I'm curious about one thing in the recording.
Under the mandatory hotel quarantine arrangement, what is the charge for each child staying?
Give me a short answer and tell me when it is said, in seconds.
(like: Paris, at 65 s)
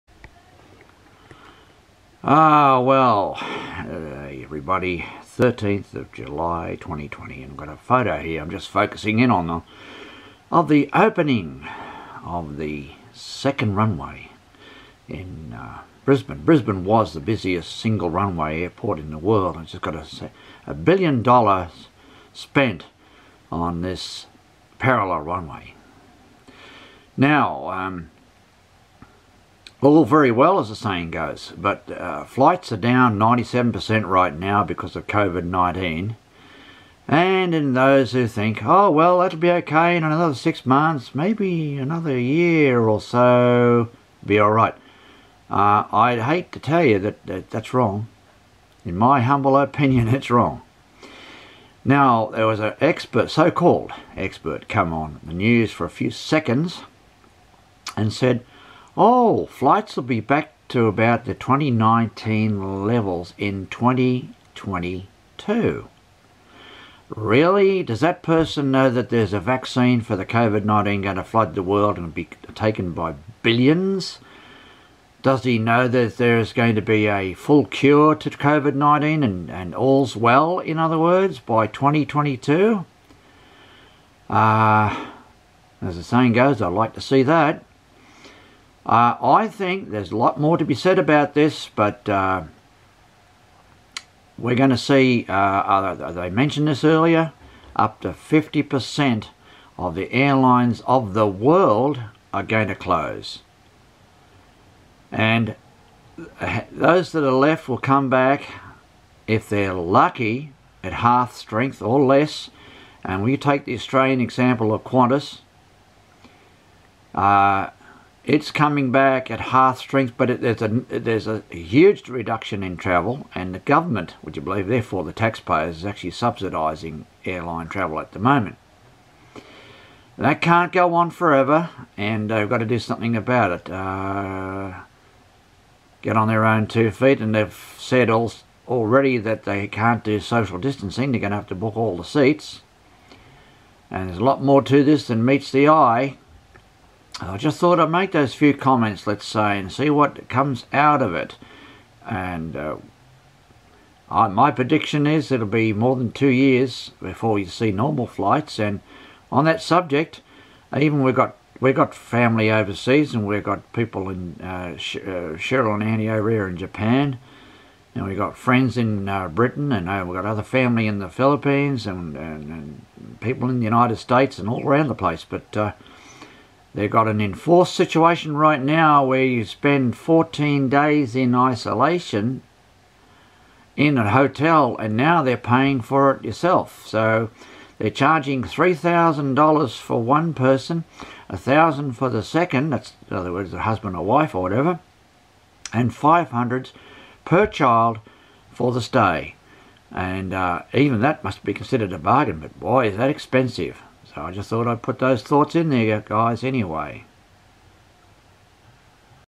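$500, at 195 s.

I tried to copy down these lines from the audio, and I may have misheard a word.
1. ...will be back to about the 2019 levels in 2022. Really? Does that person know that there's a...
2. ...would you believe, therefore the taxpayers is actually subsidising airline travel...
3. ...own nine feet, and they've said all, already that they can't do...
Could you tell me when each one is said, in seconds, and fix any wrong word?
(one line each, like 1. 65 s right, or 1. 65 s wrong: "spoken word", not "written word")
1. 59 s right
2. 124 s right
3. 136 s wrong: "two", not "nine".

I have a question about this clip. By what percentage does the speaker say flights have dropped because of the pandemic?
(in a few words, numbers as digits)
97%.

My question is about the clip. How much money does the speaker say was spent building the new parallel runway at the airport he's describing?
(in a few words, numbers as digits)
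a billion dollars.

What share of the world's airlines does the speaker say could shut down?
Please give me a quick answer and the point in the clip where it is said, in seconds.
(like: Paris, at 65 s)
up to 50%, at 97 s.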